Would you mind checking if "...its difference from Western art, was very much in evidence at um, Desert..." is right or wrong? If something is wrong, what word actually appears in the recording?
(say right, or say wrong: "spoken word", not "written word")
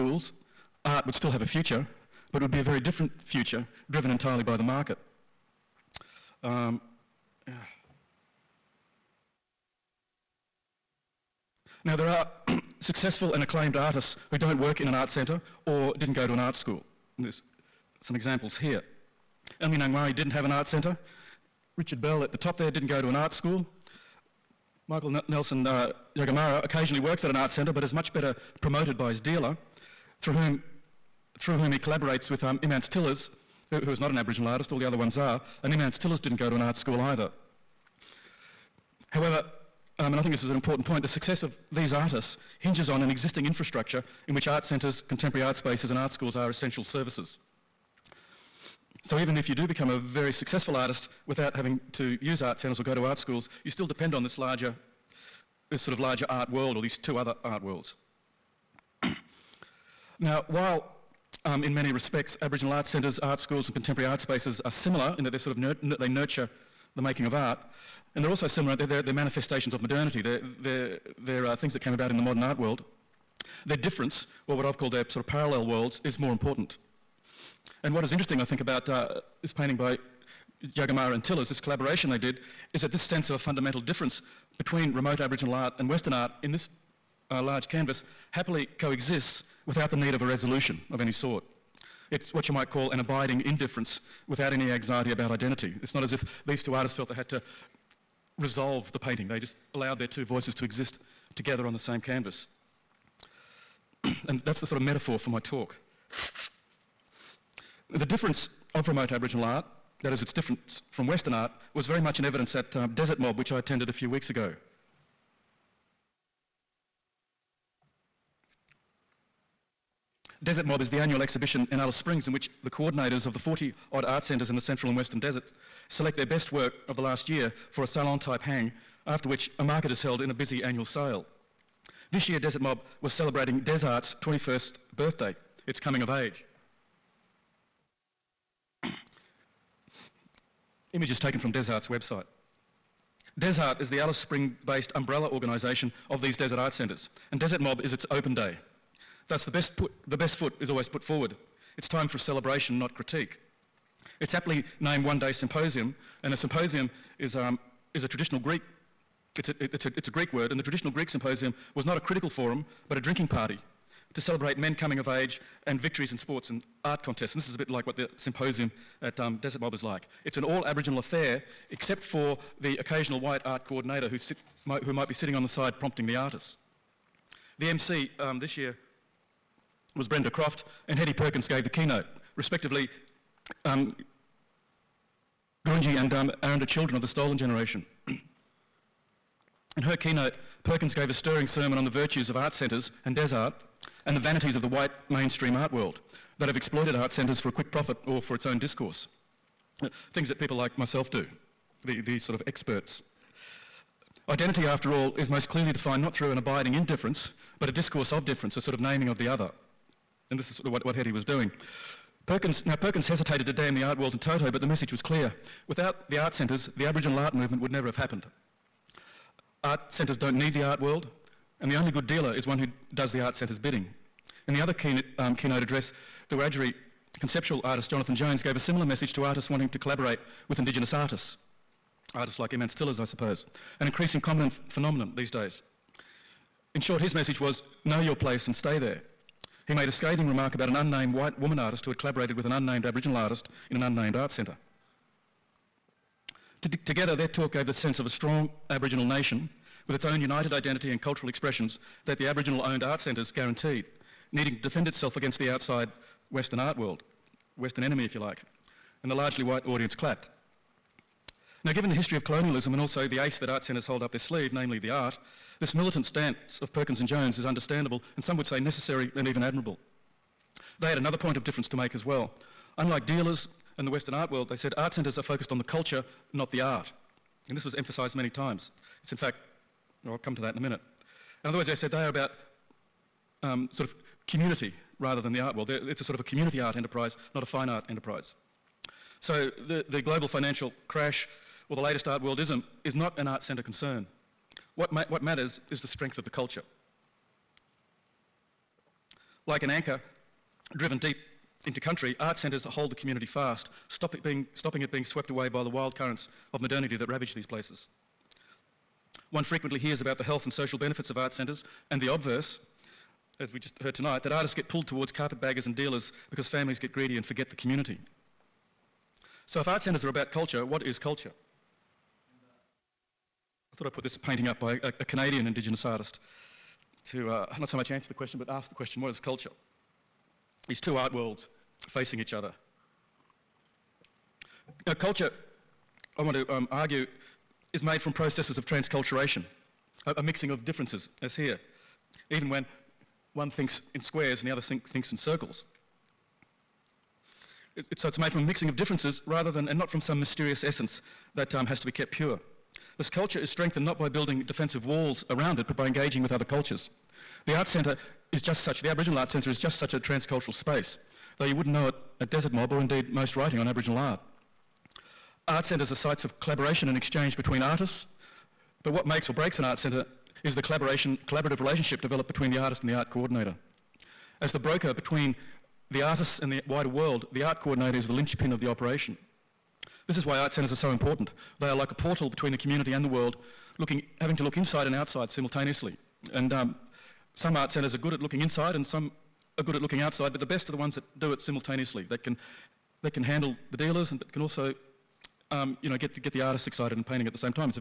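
right.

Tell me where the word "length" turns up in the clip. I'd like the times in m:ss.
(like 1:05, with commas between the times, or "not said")
not said.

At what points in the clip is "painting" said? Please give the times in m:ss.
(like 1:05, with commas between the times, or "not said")
1:19, 1:38, 5:24, 6:37.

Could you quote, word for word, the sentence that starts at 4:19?
And the largely white audience clapped.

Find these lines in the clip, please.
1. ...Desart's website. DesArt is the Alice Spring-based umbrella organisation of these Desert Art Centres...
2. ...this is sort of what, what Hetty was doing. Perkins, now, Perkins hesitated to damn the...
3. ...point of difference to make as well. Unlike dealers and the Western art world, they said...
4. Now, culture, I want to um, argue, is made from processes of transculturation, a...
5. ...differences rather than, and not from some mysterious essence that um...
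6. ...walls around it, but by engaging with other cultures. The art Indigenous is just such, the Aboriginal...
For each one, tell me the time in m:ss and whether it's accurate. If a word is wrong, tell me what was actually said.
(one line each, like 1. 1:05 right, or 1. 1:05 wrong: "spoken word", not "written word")
1. 2:21 right
2. 3:30 right
3. 4:31 right
4. 5:34 right
5. 5:48 right
6. 5:54 wrong: "Centre", not "Indigenous".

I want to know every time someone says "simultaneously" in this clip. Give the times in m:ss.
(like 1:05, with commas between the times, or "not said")
6:25, 6:31.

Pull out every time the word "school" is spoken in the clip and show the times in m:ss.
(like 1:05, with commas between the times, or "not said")
0:16, 0:23, 0:36, 0:46, 0:53, 1:03.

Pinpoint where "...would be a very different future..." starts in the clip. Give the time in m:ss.
0:02.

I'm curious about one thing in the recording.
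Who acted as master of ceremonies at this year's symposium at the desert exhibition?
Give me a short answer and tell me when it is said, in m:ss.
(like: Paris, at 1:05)
Brenda Croft, at 3:00.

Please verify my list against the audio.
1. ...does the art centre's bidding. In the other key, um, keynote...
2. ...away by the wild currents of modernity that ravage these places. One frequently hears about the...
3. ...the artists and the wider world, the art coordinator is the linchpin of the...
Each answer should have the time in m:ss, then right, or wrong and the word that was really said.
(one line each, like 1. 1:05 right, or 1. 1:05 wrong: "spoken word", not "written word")
1. 3:42 right
2. 5:05 right
3. 6:15 right.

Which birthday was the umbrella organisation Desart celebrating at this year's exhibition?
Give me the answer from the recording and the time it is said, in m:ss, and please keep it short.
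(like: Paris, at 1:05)
21st, at 2:14.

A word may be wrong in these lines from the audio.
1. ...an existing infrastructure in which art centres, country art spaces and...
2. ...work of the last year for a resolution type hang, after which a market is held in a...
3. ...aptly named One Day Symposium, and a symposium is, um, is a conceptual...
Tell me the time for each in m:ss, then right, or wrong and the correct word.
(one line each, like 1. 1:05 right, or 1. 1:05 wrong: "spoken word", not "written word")
1. 0:43 wrong: "contemporary", not "country"
2. 2:06 wrong: "salon", not "resolution"
3. 2:34 wrong: "traditional", not "conceptual".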